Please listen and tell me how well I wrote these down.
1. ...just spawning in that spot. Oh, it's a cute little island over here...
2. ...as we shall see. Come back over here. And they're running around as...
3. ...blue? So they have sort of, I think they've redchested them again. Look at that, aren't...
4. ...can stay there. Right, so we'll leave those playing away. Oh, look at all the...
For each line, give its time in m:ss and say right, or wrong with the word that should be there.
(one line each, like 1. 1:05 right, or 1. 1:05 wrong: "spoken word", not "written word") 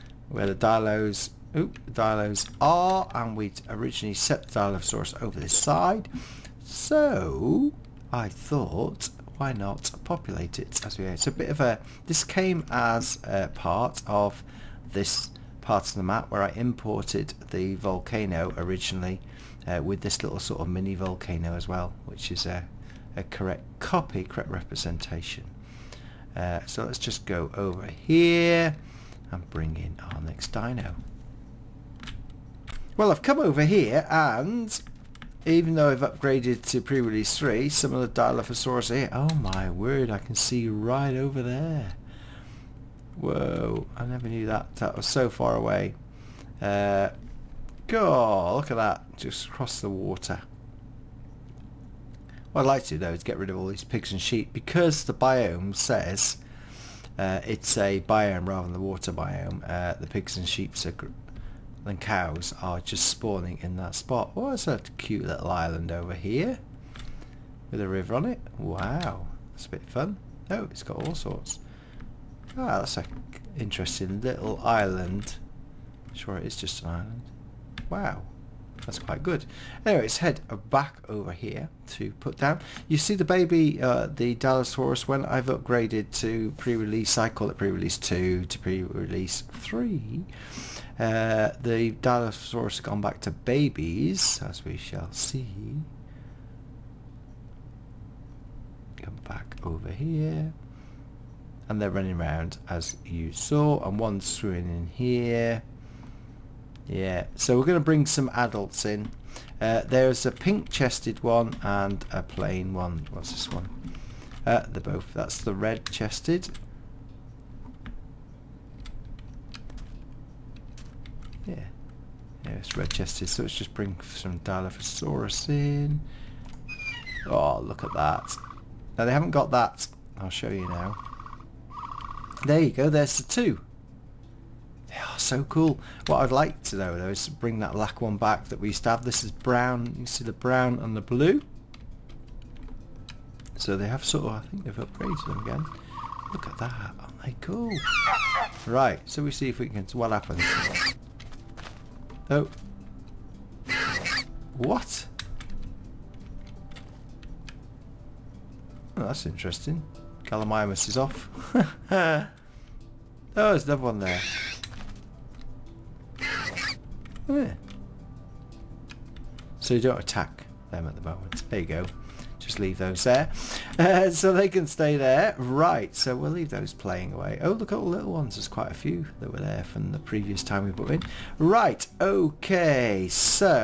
1. 1:02 right
2. 1:34 right
3. 2:20 wrong: "upgraded", not "redchested"
4. 2:54 right.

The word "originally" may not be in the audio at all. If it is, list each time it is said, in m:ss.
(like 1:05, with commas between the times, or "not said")
0:03, 0:18.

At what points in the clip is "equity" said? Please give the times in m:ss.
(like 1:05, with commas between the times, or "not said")
not said.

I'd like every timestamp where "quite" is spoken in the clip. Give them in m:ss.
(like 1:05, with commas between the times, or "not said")
1:18, 2:58.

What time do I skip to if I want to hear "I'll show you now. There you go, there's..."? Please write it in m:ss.
2:10.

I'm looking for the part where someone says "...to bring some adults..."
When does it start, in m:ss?
1:47.